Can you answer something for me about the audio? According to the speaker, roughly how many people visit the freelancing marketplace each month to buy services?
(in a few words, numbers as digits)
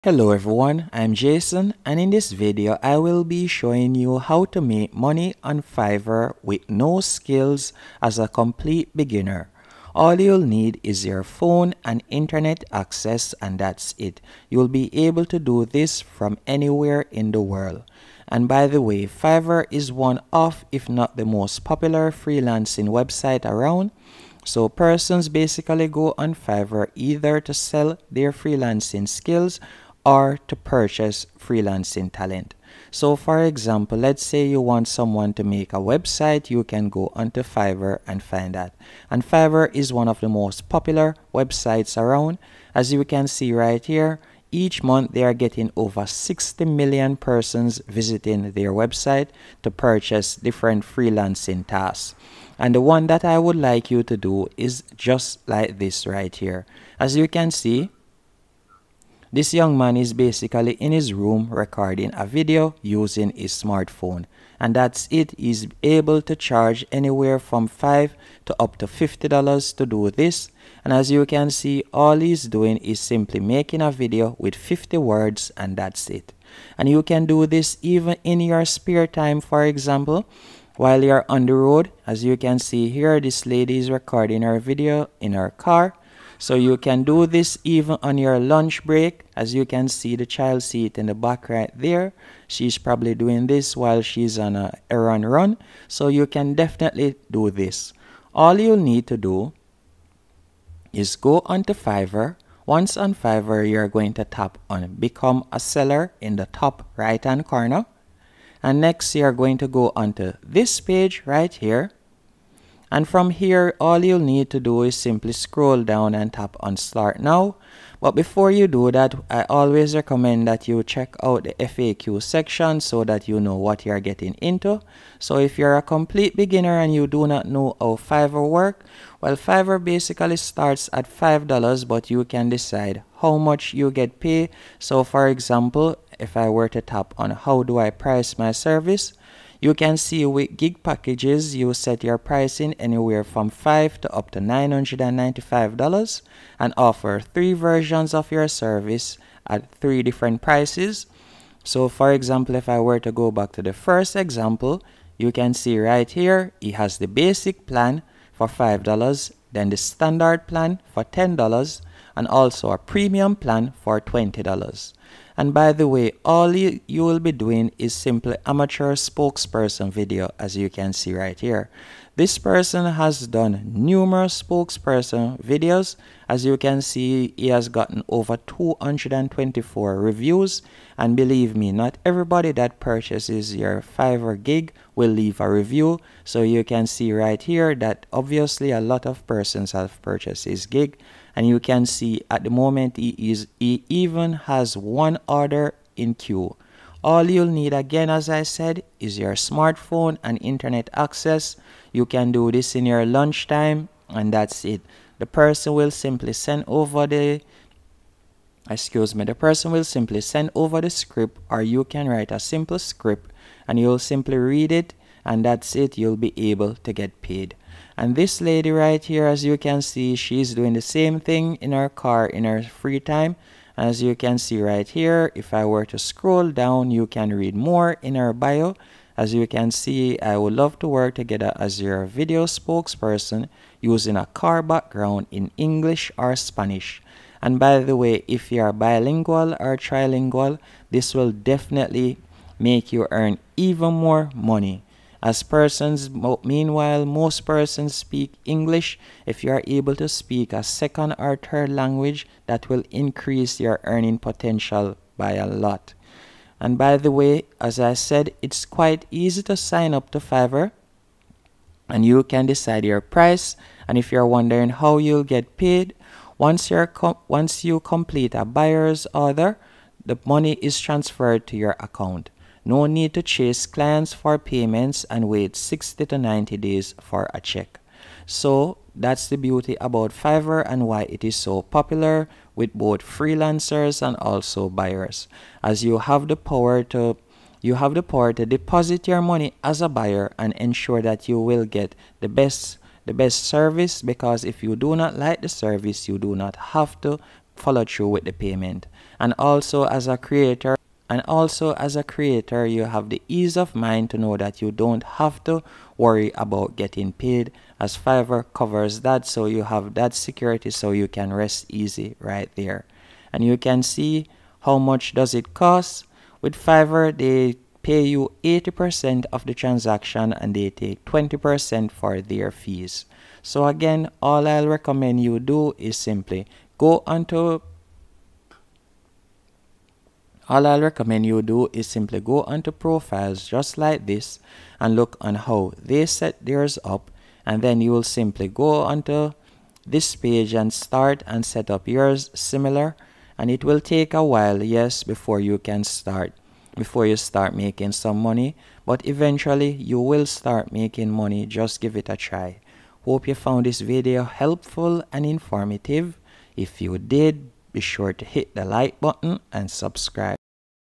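60 million.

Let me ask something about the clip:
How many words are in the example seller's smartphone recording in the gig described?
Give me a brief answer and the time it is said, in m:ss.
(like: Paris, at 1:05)
50, at 1:14.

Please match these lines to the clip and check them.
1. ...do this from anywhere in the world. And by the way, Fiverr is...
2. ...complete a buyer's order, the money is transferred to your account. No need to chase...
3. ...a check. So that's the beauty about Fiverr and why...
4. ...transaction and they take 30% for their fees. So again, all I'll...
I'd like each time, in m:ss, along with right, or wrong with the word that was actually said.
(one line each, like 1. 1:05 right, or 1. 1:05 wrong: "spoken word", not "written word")
1. 0:15 right
2. 4:27 right
3. 4:37 right
4. 5:19 wrong: "20", not "30".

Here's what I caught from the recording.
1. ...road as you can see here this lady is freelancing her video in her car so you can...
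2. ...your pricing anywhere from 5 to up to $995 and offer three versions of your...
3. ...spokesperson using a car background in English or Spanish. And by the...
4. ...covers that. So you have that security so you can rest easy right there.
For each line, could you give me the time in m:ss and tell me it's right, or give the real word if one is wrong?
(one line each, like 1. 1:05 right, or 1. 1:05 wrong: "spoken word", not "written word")
1. 1:21 wrong: "recording", not "freelancing"
2. 2:22 right
3. 3:52 right
4. 5:08 right.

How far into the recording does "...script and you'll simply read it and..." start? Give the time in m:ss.
3:32.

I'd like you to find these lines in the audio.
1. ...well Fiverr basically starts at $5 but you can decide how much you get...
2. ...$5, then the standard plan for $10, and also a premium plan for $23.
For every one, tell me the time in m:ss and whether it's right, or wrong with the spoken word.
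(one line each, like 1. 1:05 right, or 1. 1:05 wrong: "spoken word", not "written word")
1. 2:09 right
2. 2:38 wrong: "20", not "23".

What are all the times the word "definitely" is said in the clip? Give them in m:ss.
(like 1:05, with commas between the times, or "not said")
1:36, 4:01.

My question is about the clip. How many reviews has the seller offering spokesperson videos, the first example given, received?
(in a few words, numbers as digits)
224.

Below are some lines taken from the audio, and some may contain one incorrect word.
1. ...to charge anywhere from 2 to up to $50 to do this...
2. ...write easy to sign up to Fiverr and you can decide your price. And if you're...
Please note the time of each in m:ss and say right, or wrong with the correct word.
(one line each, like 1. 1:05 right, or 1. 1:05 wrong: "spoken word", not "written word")
1. 1:06 wrong: "5", not "2"
2. 4:18 wrong: "quite", not "write".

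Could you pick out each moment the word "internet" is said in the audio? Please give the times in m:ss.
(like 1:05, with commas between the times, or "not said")
0:12, 3:20.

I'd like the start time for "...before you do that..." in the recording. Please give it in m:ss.
1:58.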